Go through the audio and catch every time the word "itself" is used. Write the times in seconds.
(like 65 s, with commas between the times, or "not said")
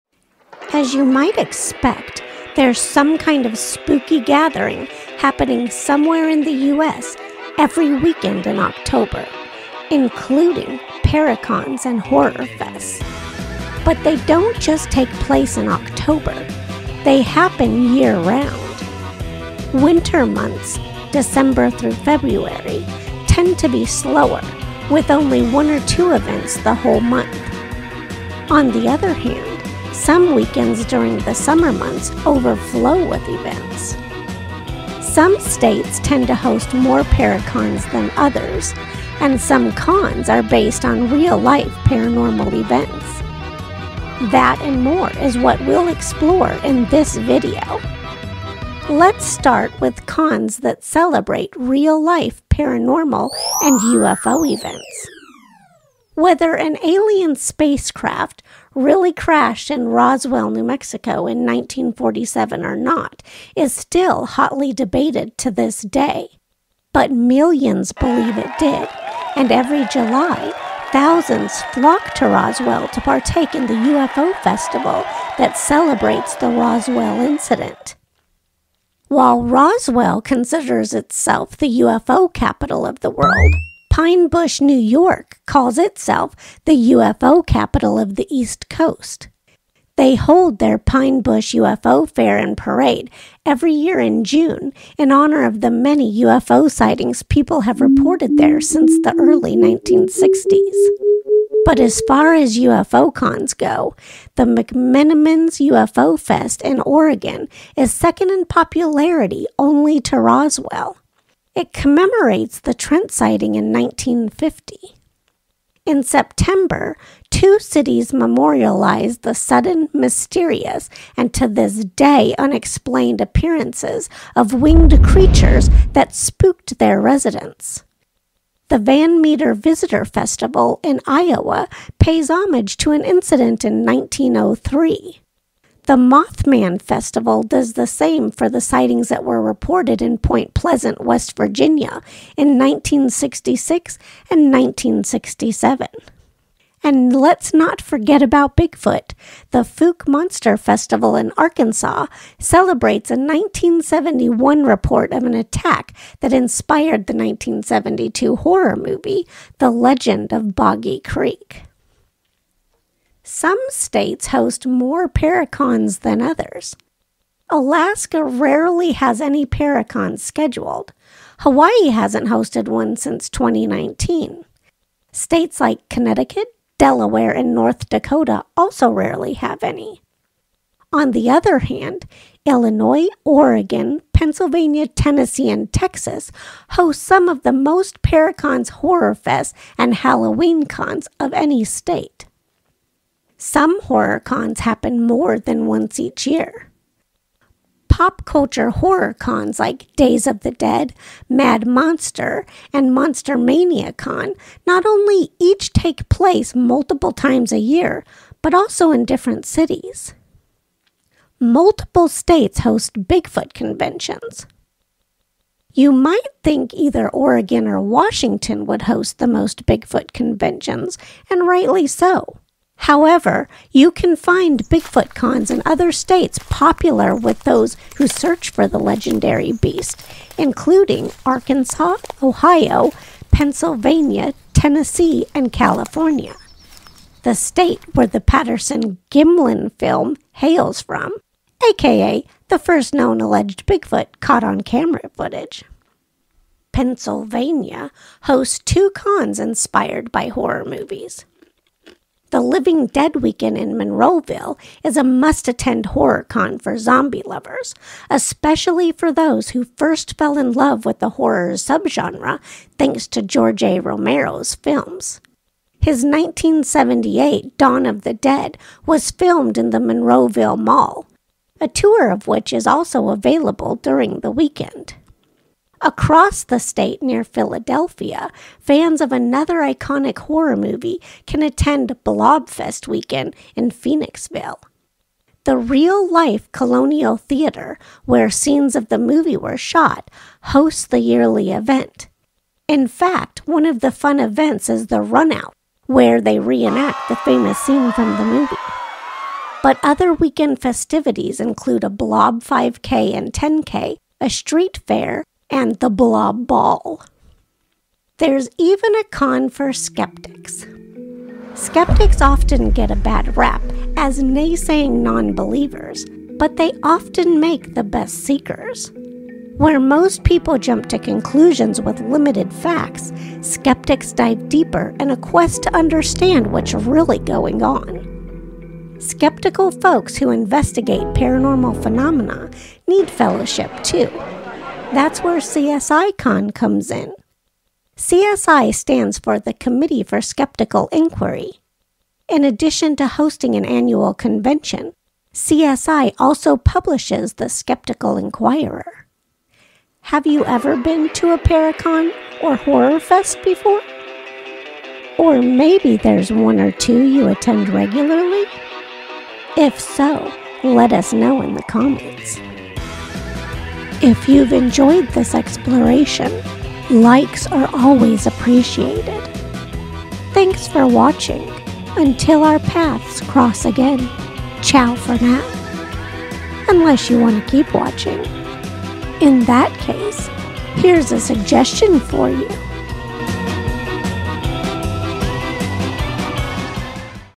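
80 s, 85 s.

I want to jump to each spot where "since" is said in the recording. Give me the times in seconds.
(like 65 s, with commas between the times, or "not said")
98 s, 172 s.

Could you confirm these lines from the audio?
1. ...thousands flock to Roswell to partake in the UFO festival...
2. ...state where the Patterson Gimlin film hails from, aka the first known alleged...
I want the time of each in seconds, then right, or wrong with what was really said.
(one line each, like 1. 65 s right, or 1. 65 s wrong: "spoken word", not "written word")
1. 70 s right
2. 237 s right.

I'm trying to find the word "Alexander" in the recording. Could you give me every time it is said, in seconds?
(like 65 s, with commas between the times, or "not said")
not said.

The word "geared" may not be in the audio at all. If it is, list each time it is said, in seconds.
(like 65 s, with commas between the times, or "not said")
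not said.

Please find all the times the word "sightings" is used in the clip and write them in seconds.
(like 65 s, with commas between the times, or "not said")
96 s, 113 s, 138 s.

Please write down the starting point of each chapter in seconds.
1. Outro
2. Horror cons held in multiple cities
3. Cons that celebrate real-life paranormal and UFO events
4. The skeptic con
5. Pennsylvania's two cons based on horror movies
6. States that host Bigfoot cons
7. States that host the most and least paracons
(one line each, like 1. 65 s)
1. 350 s
2. 195 s
3. 51 s
4. 310 s
5. 248 s
6. 212 s
7. 165 s.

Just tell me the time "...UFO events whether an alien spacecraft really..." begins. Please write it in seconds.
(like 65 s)
53 s.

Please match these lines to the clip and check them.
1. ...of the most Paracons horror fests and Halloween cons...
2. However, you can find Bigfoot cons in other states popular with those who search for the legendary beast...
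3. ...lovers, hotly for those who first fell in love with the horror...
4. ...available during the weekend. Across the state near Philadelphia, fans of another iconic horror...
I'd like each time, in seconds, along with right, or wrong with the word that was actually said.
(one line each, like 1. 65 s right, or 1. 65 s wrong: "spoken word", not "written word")
1. 187 s right
2. 222 s right
3. 257 s wrong: "especially", not "hotly"
4. 273 s right.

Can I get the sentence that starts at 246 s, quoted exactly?
Pennsylvania hosts two cons inspired by horror movies.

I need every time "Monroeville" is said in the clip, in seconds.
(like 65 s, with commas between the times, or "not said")
253 s, 269 s.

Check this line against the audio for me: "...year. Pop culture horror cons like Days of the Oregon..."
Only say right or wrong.
wrong.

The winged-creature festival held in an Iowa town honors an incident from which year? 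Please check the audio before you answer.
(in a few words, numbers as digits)
1903.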